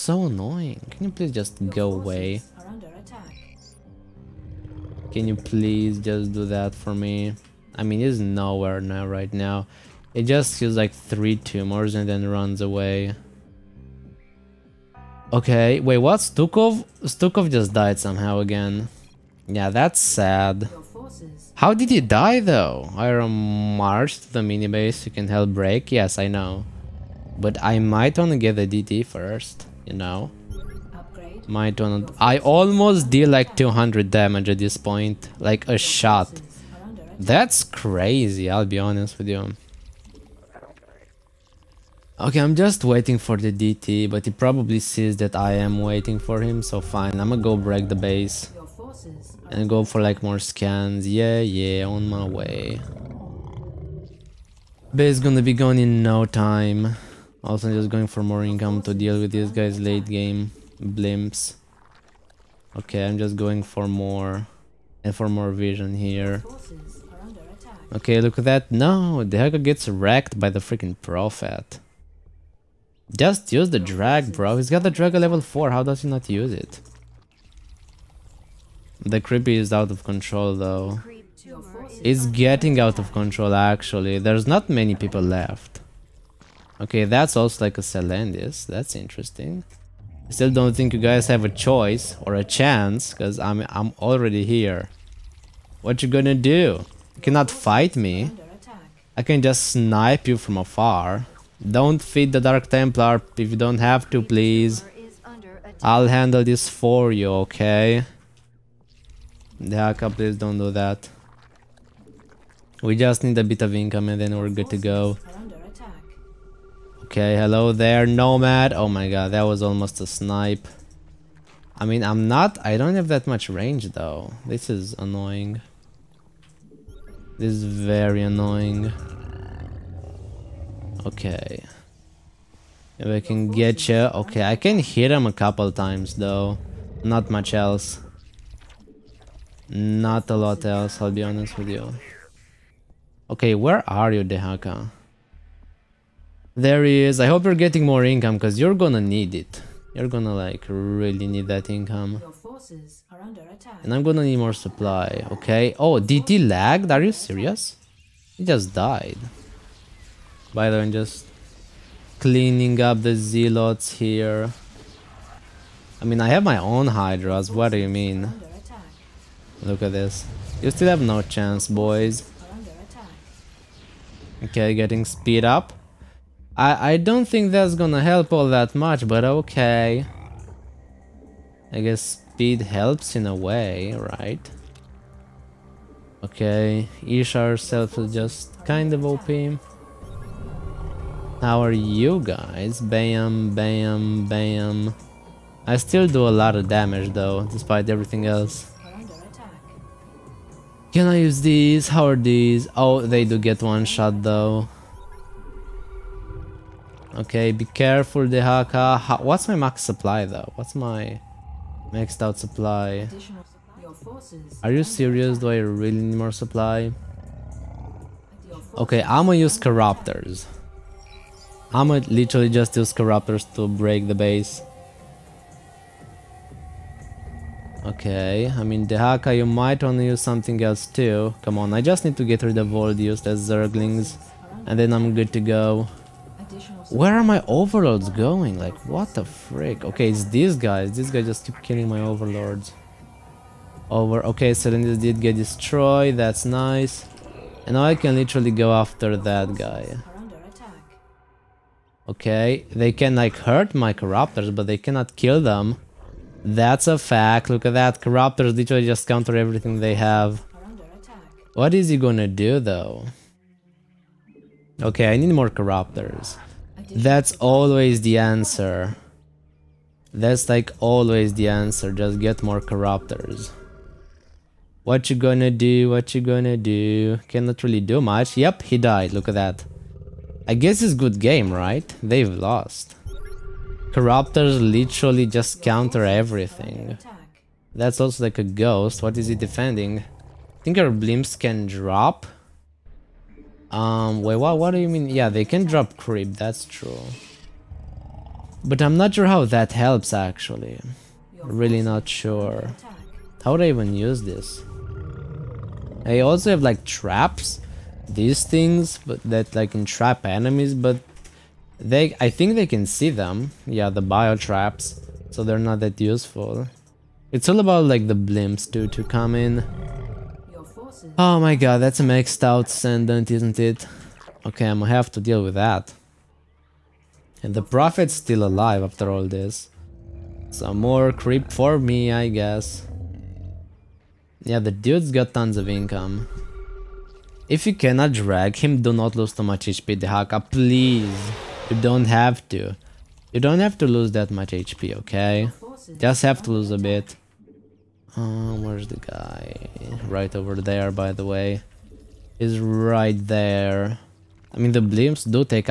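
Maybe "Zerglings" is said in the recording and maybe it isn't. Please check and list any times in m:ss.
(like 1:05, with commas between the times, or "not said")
3:53.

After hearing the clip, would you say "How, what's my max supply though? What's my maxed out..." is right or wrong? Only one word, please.
right.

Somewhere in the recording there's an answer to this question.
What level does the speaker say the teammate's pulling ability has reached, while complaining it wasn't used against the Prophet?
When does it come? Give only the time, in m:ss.
1:15.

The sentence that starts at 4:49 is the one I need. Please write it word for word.
I think our blimps can drop.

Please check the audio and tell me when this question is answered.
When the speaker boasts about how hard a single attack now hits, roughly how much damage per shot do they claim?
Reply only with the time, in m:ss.
0:33.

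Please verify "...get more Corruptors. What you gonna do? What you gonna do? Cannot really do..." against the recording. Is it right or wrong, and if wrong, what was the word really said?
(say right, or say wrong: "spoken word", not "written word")
right.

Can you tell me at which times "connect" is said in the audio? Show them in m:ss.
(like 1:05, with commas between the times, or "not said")
not said.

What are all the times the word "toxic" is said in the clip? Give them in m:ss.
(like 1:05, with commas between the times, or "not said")
not said.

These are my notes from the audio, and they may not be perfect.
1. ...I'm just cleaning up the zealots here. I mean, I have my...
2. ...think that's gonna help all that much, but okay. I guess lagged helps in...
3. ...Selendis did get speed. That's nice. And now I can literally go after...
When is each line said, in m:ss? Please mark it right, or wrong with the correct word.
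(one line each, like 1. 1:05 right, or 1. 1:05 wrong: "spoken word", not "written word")
1. 2:40 right
2. 2:57 wrong: "speed", not "lagged"
3. 4:04 wrong: "destroyed", not "speed".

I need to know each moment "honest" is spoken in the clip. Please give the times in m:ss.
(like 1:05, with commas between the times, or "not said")
0:38, 2:21.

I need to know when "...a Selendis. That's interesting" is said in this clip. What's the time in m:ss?
1:27.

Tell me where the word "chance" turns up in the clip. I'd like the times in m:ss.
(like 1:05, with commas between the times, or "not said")
1:32, 2:51.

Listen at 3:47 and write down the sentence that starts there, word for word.
Okay, I mean Dehaka you might want to use something else too.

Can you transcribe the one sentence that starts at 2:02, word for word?
I don't have that much range, though.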